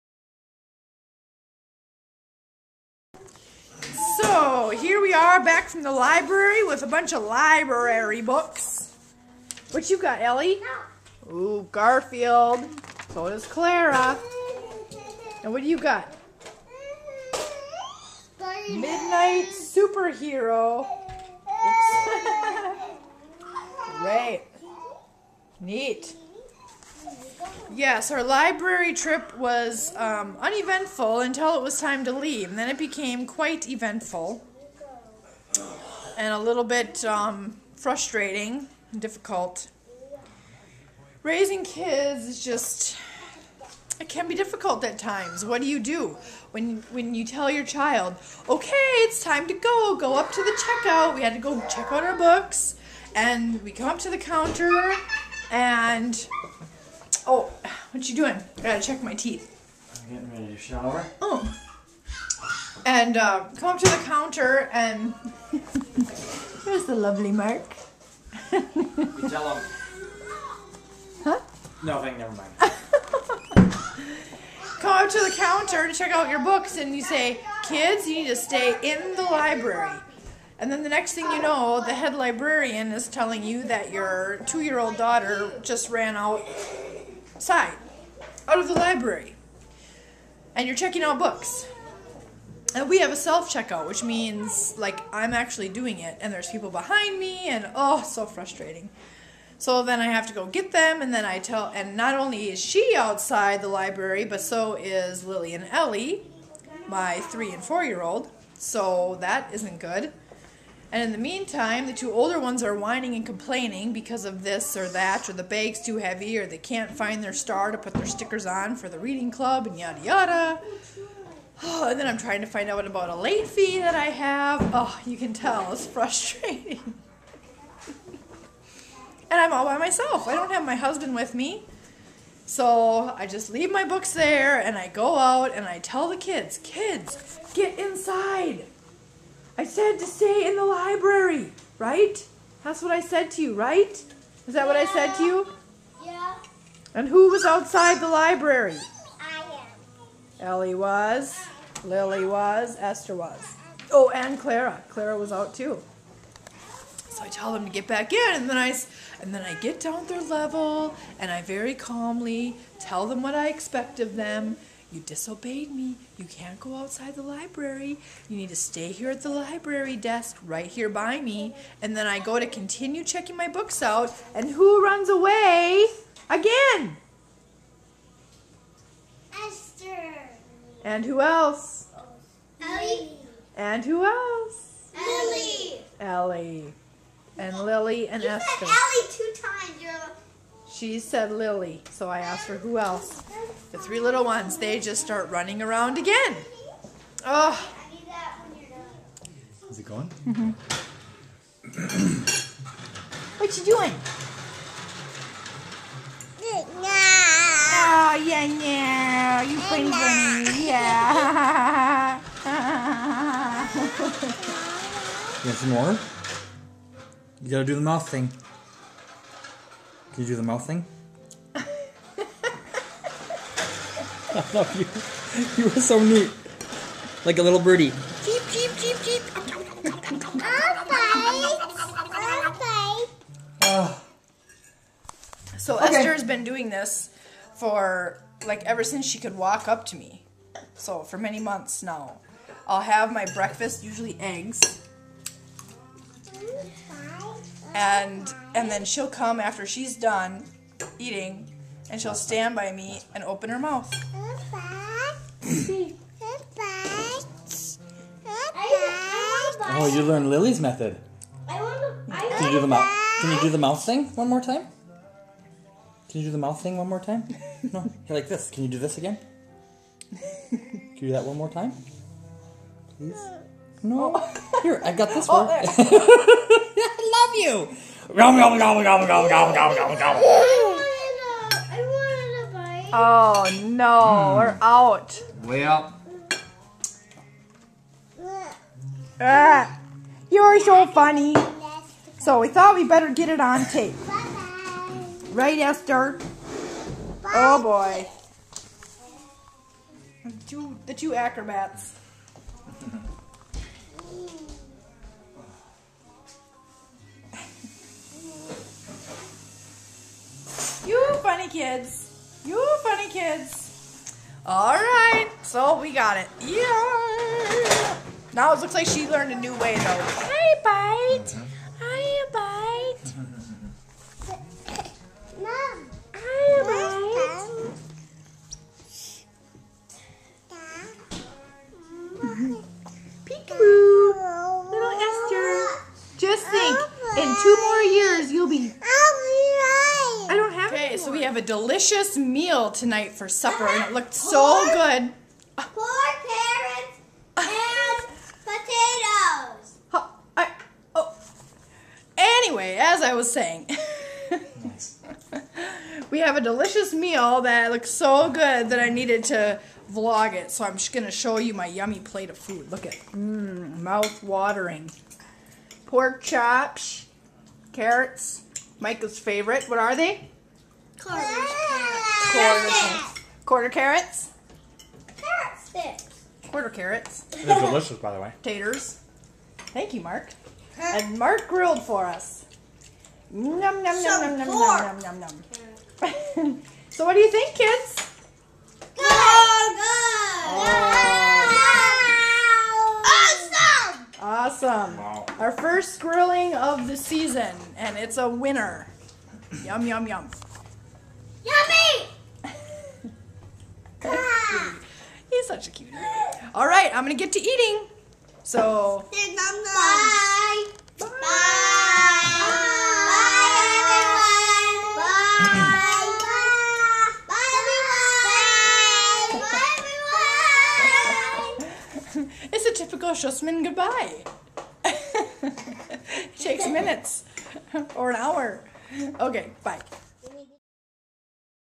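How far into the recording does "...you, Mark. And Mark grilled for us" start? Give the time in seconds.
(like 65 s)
379 s.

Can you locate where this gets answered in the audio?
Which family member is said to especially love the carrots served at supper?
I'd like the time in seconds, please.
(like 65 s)
368 s.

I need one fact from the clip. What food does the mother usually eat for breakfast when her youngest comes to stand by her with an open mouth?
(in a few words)
Eggs.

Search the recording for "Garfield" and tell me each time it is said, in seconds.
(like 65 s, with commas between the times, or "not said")
11 s.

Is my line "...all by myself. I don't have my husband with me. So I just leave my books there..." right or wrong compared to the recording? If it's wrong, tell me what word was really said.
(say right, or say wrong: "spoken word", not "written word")
right.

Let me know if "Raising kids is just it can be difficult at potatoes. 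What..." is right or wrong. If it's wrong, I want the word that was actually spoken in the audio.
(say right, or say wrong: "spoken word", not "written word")
wrong: "times", not "potatoes".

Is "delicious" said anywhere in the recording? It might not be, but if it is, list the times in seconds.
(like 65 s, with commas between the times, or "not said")
341 s, 356 s, 377 s.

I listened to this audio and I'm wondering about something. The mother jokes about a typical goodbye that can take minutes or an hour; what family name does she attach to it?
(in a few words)
Schussman.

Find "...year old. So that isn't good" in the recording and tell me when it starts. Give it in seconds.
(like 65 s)
107 s.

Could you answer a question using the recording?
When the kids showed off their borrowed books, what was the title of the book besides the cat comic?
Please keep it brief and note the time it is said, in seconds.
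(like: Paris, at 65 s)
Midnight Superhero, at 18 s.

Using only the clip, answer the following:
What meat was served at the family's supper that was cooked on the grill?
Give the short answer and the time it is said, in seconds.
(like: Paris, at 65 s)
Pork chops, at 365 s.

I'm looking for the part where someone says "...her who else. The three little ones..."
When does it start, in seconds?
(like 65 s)
192 s.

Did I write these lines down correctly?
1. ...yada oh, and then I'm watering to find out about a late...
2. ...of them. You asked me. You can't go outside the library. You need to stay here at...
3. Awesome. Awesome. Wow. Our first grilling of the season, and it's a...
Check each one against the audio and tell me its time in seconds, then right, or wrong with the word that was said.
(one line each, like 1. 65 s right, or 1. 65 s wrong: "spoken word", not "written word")
1. 120 s wrong: "trying", not "watering"
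2. 163 s wrong: "disobeyed", not "asked"
3. 394 s right.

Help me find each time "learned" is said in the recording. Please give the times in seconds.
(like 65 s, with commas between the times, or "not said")
260 s, 319 s.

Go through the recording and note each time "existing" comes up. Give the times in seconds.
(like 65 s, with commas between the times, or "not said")
not said.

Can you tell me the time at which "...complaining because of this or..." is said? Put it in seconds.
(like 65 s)
113 s.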